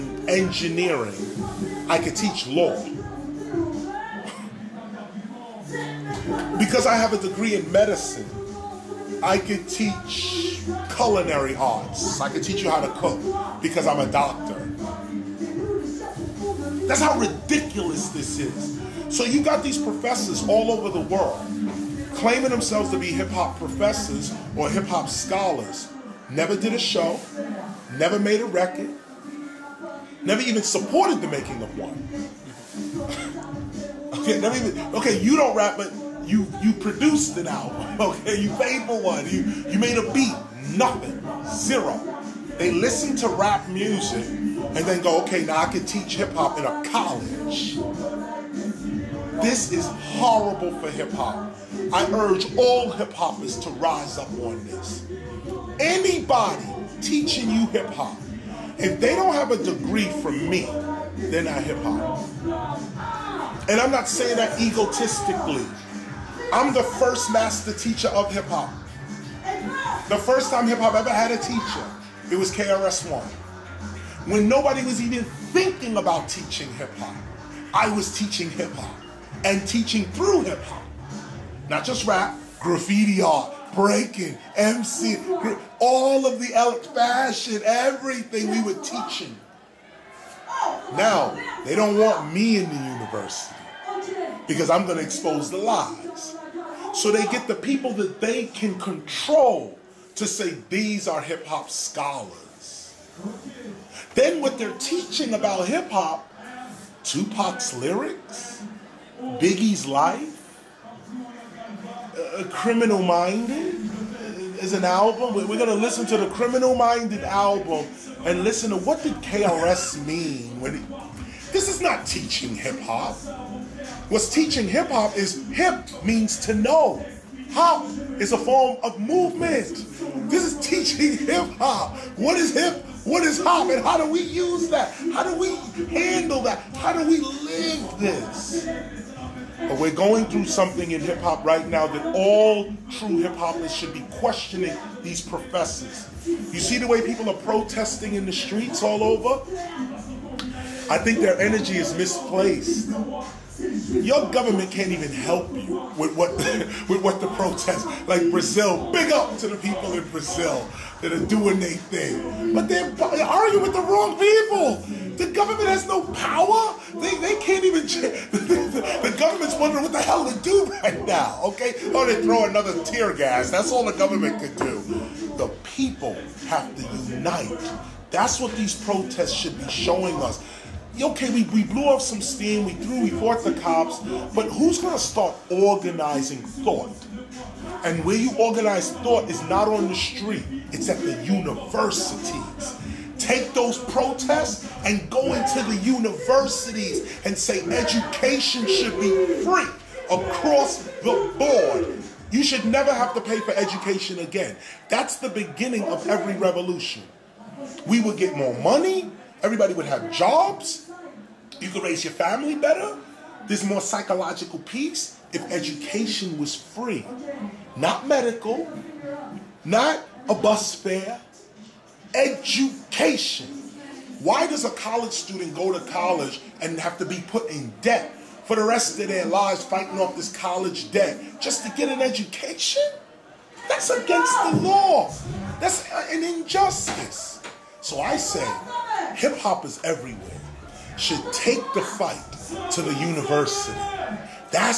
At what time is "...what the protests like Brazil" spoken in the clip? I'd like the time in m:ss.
2:37.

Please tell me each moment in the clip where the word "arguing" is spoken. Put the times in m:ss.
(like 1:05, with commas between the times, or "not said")
2:43.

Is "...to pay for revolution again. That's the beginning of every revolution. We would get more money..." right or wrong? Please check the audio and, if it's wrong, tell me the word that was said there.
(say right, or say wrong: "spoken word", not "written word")
wrong: "education", not "revolution".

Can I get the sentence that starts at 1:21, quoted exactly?
Not just rap, graffiti art, breaking, MC, all of the fashion, everything we were teaching.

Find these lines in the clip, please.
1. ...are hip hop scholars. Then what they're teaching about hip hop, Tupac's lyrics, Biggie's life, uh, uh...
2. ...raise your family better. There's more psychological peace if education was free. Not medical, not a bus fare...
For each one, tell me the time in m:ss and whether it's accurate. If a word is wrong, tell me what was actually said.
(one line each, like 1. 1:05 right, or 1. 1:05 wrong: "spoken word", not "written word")
1. 1:41 right
2. 3:31 right.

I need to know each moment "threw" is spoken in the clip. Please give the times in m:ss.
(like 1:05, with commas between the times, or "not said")
3:02.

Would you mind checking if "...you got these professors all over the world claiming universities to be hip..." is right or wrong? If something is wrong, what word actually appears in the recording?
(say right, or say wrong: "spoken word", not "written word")
wrong: "themselves", not "universities".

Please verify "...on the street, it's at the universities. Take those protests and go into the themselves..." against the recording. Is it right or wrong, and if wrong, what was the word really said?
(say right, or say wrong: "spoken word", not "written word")
wrong: "universities", not "themselves".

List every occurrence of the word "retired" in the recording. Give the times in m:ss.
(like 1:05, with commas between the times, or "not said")
not said.